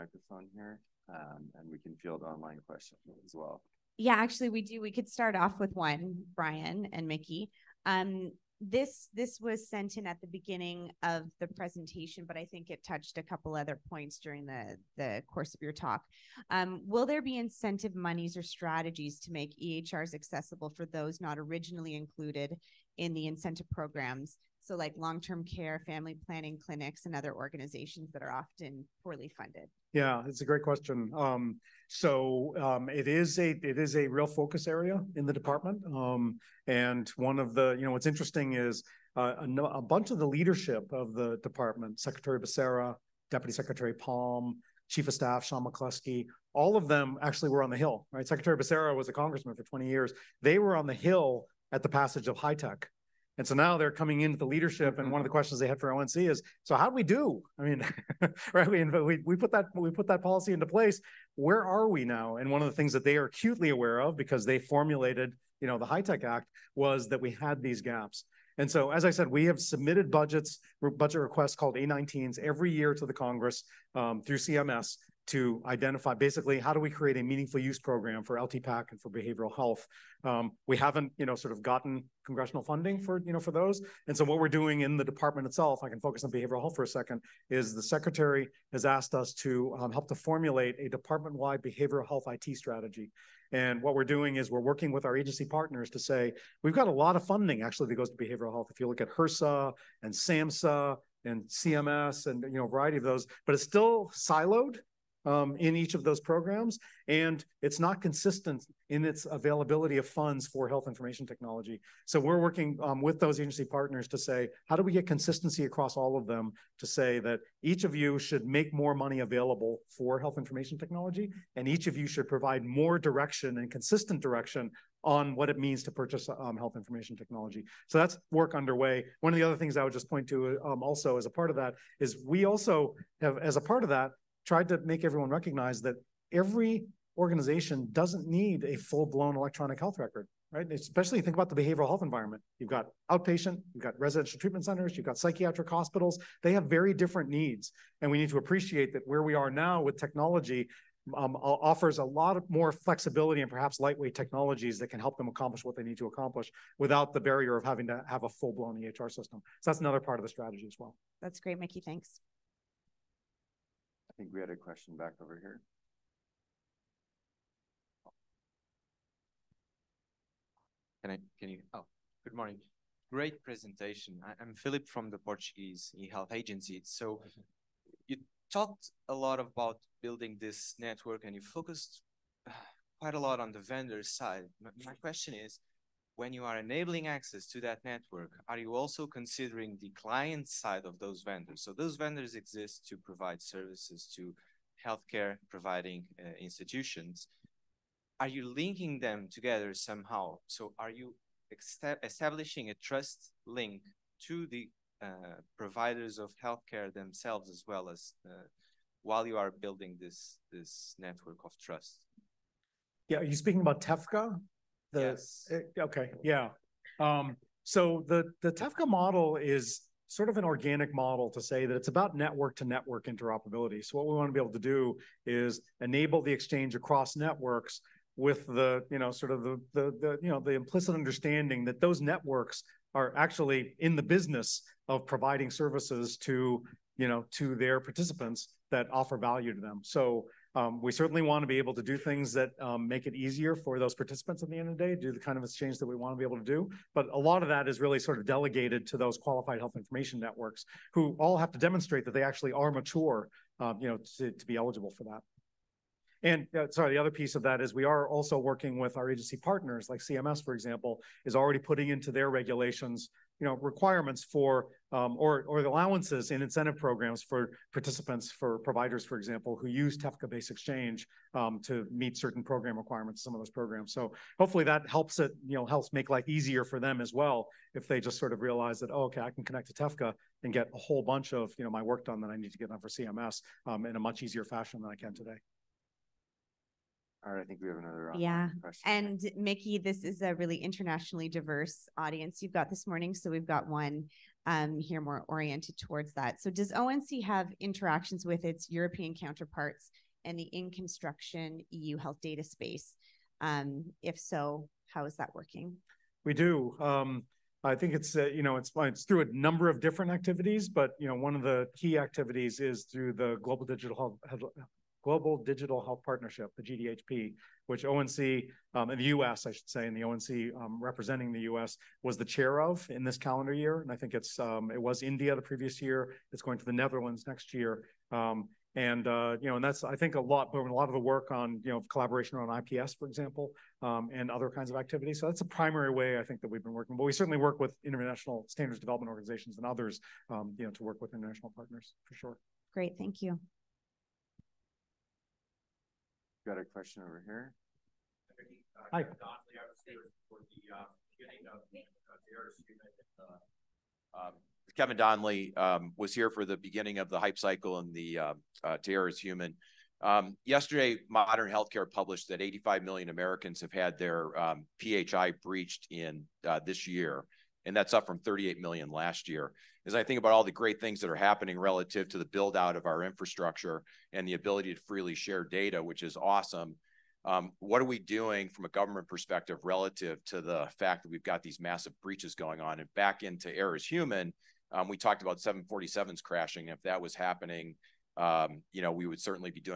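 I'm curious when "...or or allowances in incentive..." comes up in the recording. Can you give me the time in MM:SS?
04:25.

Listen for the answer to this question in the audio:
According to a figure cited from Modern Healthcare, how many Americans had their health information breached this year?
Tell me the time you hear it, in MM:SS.
06:02.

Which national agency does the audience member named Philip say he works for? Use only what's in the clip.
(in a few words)
Portuguese eHealth Agency.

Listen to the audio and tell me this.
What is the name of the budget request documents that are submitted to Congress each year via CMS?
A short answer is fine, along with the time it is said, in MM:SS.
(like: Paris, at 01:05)
A19s, at 01:11.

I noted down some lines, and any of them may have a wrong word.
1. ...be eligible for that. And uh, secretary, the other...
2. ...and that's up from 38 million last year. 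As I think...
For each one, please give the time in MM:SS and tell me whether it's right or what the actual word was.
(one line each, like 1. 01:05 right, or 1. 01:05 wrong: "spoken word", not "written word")
1. 04:14 wrong: "sorry", not "secretary"
2. 06:07 right.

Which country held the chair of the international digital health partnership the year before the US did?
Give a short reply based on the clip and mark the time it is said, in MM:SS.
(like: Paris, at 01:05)
India, at 05:25.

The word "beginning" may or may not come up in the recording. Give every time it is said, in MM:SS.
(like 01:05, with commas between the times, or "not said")
00:10, 05:56.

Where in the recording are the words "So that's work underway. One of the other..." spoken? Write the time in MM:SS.
02:07.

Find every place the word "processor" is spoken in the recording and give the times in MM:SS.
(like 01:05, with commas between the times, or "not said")
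not said.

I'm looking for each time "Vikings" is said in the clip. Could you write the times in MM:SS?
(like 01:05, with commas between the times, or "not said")
not said.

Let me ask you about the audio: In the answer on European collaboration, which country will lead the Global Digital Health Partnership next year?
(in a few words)
The Netherlands.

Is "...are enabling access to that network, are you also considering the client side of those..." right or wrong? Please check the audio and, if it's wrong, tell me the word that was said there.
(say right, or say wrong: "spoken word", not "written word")
right.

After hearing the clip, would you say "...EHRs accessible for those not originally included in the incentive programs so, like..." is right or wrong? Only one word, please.
right.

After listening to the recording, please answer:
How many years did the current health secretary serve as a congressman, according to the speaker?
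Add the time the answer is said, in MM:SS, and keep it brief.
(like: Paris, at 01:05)
20, at 00:49.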